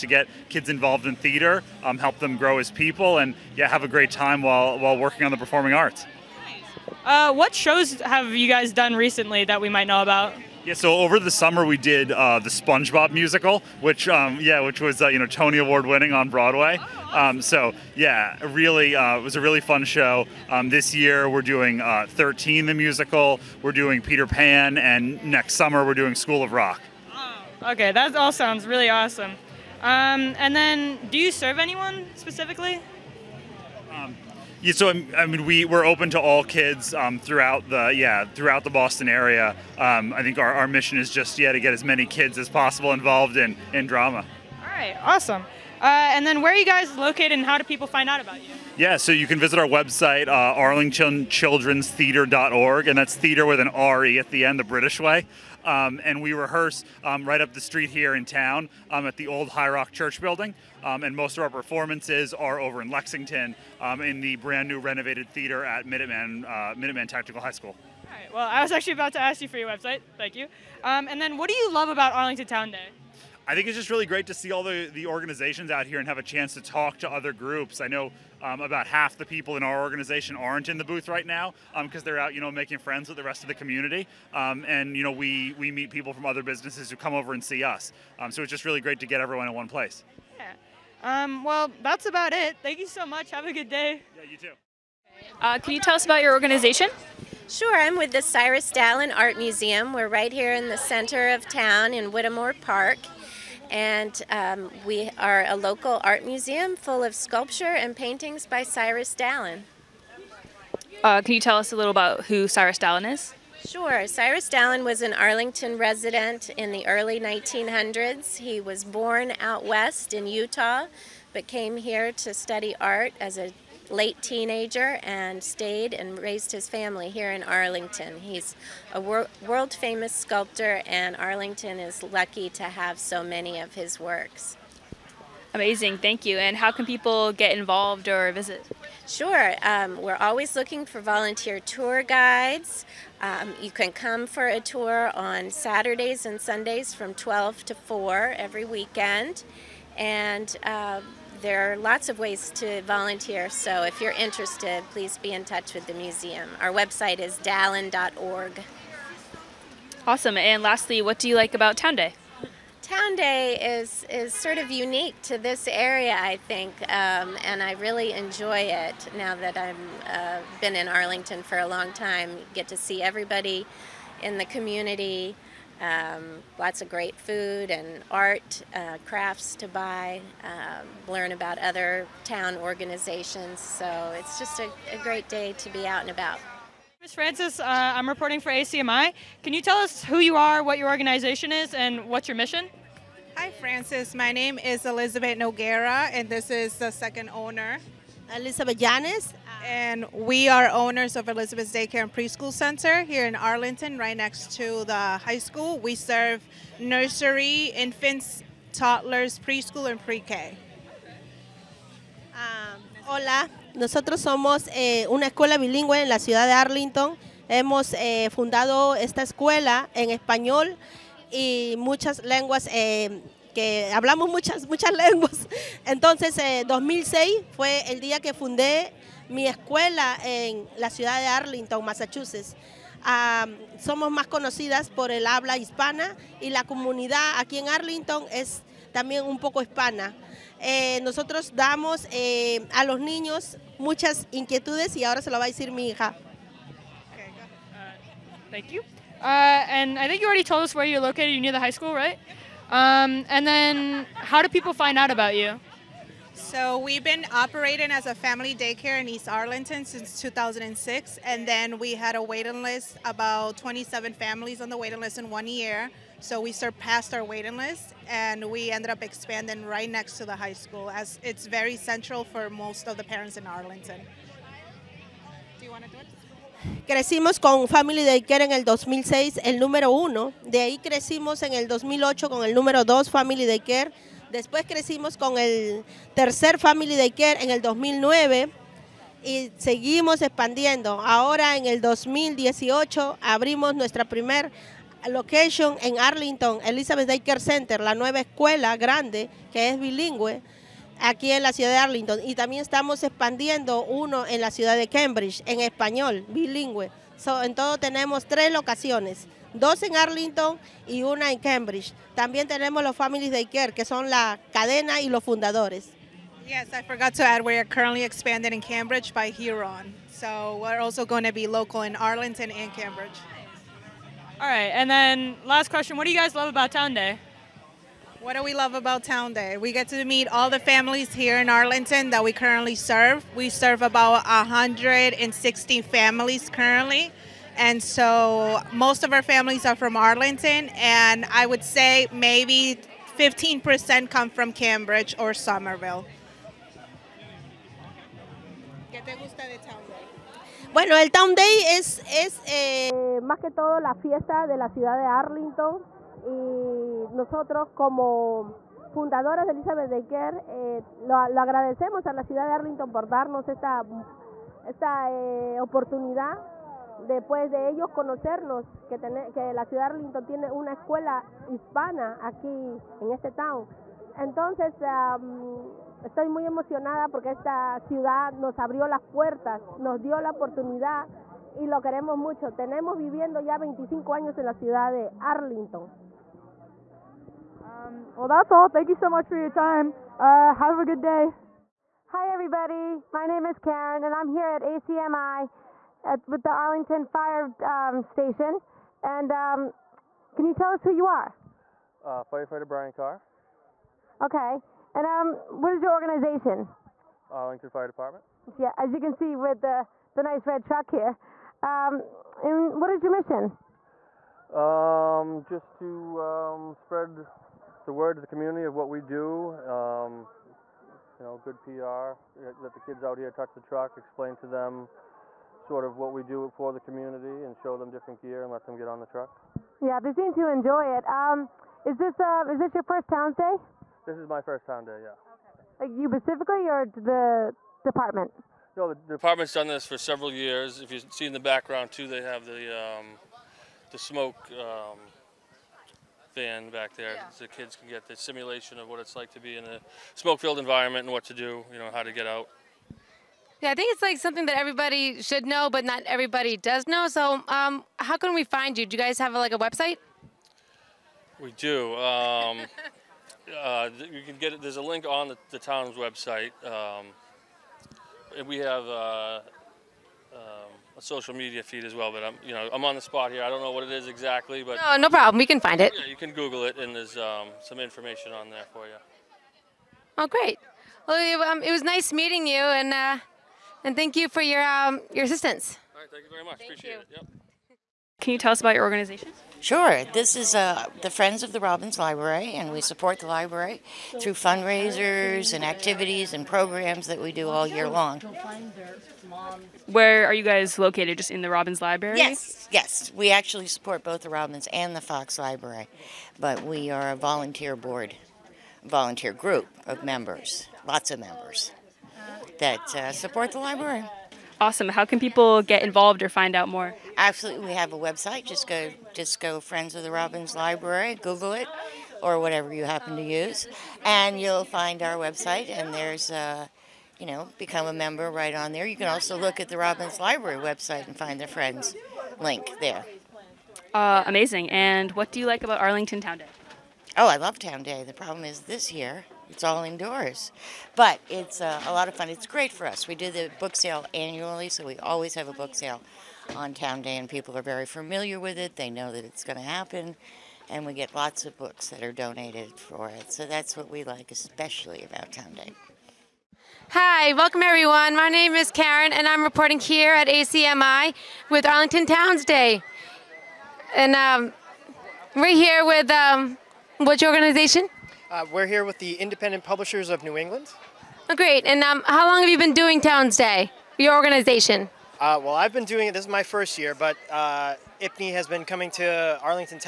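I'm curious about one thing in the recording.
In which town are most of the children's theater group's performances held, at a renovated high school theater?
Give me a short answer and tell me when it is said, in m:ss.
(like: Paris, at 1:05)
Lexington, at 1:02.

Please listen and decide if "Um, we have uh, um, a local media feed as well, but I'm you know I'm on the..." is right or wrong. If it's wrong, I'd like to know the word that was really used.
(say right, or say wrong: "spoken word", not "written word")
wrong: "social", not "local".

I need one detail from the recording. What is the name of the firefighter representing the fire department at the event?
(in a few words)
Brian Carr.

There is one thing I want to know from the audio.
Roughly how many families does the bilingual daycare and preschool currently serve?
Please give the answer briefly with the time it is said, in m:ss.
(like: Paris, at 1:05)
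160, at 5:34.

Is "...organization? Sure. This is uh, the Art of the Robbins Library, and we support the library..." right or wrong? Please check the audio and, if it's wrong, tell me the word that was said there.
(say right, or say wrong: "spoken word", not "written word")
wrong: "Friends", not "Art".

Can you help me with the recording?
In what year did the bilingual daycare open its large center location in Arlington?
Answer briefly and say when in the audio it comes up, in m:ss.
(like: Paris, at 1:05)
2018, at 4:51.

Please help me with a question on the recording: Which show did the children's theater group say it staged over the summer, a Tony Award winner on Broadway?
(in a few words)
The SpongeBob Musical.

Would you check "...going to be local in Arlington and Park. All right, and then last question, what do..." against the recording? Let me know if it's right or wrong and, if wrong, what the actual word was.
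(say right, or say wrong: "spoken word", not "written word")
wrong: "Cambridge", not "Park".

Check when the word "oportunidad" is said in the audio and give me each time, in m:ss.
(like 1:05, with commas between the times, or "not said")
6:05, 6:20.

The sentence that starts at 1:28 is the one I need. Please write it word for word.
Um, so it's just really great to get everyone in one place.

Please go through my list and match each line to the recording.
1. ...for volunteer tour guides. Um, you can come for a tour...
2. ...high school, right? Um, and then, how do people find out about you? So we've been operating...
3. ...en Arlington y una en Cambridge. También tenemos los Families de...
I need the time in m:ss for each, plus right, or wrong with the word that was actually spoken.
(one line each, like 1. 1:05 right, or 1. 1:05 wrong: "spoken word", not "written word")
1. 2:20 right
2. 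4:11 right
3. 5:09 right.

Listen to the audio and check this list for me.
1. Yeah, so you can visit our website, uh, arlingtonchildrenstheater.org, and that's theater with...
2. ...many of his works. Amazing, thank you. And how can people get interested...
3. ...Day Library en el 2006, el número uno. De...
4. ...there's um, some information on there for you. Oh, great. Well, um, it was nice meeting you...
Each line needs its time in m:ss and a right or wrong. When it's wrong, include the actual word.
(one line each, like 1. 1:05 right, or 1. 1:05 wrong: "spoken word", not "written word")
1. 0:48 right
2. 2:13 wrong: "involved", not "interested"
3. 4:38 wrong: "Care", not "Library"
4. 7:56 right.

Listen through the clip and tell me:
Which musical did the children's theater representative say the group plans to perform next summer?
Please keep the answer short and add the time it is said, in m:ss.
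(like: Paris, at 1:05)
School of Rock, at 0:26.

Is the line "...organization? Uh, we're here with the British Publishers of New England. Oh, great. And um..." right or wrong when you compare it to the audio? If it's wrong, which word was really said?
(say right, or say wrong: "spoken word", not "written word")
wrong: "Independent", not "British".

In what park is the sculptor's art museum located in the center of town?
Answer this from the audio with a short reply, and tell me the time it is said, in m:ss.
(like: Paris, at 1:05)
Whittemore Park, at 1:42.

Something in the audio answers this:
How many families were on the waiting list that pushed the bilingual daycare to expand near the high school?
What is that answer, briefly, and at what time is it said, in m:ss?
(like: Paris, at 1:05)
27, at 4:23.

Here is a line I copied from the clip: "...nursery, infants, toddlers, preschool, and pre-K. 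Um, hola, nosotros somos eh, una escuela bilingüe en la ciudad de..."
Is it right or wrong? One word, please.
right.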